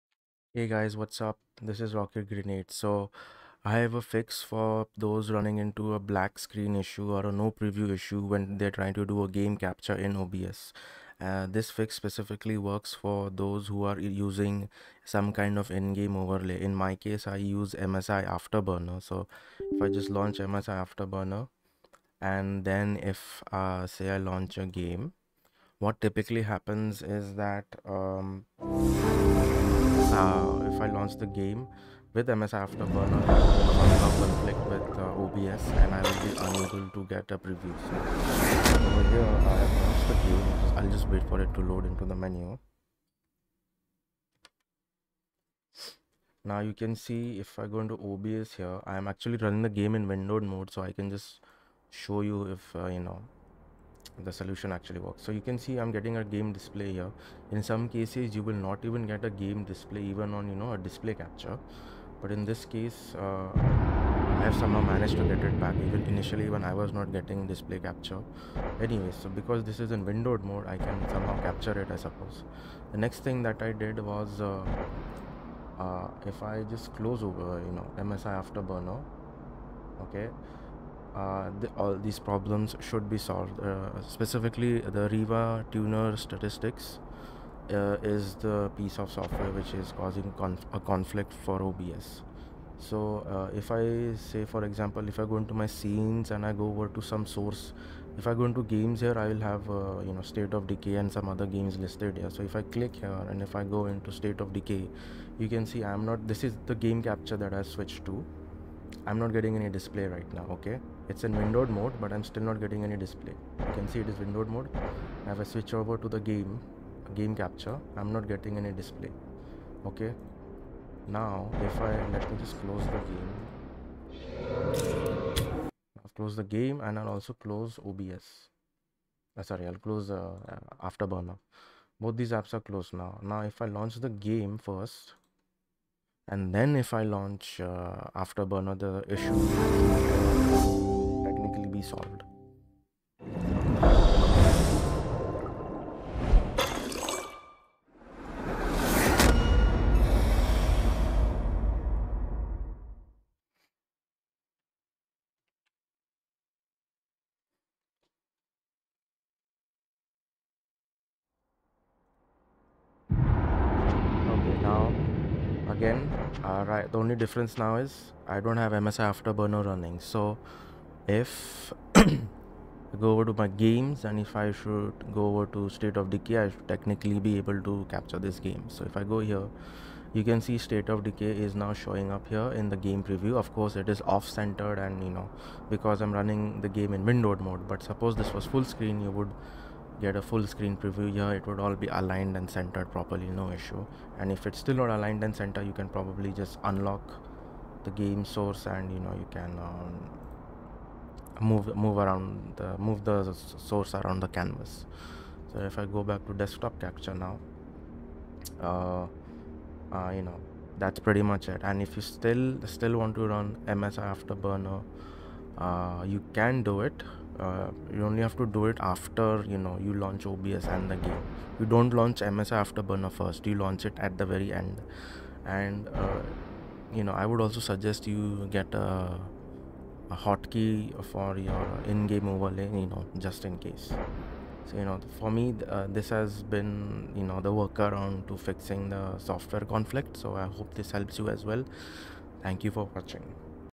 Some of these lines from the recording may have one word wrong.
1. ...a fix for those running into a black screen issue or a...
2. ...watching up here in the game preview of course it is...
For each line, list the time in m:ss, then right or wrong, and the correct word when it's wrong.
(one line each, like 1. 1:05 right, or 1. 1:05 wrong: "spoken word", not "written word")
1. 0:03 right
2. 3:01 wrong: "showing", not "watching".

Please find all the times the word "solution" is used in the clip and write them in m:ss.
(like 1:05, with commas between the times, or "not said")
0:54.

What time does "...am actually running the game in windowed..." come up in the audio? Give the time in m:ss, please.
0:48.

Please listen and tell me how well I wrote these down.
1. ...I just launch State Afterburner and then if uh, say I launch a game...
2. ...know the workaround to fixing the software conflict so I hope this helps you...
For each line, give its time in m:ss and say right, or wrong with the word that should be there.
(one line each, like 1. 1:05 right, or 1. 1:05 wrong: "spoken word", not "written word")
1. 0:19 wrong: "MSI", not "State"
2. 3:57 right.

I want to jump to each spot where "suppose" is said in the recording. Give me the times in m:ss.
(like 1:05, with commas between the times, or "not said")
1:11, 3:07.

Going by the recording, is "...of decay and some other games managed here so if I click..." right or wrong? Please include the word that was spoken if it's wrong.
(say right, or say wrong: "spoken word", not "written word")
wrong: "listed", not "managed".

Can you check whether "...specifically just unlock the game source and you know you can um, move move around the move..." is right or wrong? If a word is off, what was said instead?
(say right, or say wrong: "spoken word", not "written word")
wrong: "probably", not "specifically".